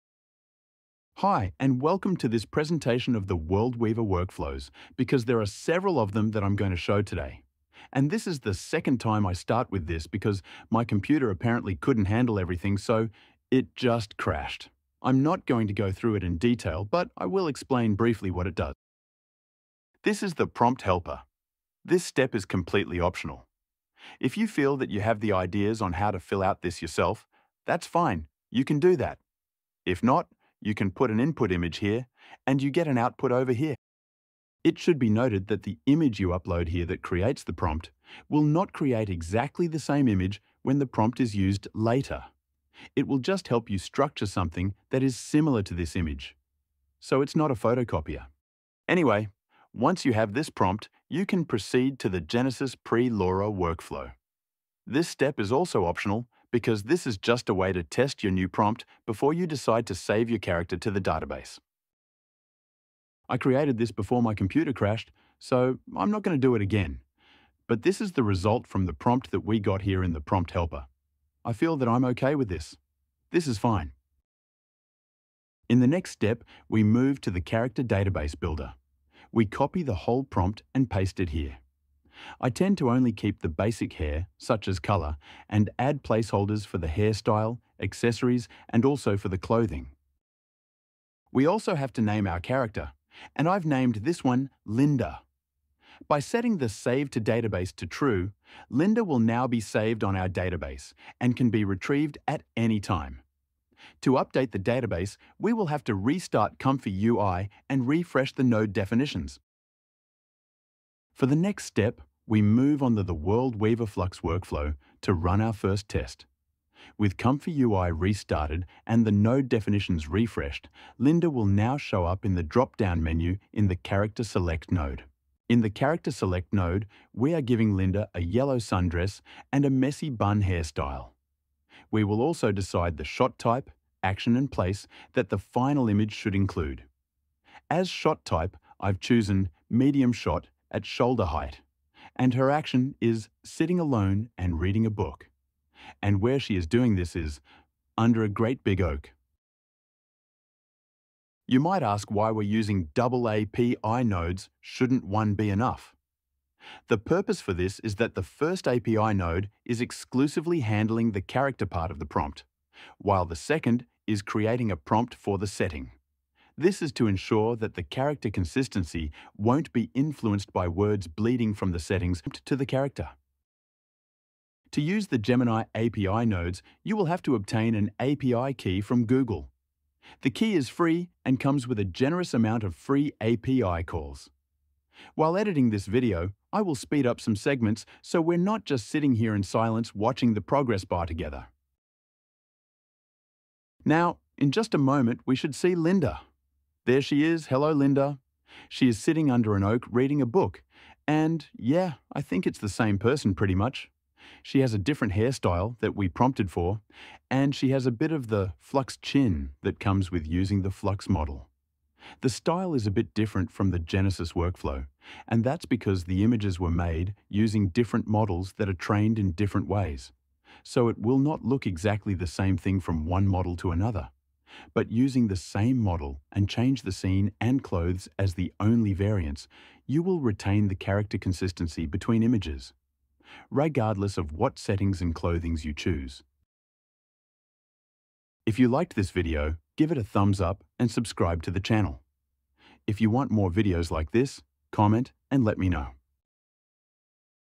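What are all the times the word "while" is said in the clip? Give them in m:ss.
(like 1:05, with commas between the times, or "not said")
2:42, 3:05.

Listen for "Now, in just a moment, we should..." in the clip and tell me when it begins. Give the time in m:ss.
3:13.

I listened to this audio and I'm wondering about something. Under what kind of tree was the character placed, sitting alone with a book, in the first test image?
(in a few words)
An oak.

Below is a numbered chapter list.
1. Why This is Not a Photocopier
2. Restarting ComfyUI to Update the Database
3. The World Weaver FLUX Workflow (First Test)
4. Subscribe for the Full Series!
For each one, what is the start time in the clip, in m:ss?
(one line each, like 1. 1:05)
1. 0:42
2. 1:40
3. 1:55
4. 3:45.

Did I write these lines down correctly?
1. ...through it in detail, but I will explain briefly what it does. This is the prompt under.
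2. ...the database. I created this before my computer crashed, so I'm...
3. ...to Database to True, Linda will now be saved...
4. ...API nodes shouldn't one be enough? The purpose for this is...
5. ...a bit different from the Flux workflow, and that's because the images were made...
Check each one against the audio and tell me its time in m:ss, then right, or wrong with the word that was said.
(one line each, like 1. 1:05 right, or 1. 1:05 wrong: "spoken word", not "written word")
1. 0:15 wrong: "helper", not "under"
2. 1:00 right
3. 1:37 right
4. 2:32 right
5. 3:32 wrong: "Genesis", not "Flux".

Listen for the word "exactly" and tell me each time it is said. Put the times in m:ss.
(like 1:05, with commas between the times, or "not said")
0:39, 3:41.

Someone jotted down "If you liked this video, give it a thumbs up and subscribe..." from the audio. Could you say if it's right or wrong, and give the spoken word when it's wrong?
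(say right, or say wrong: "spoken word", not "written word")
right.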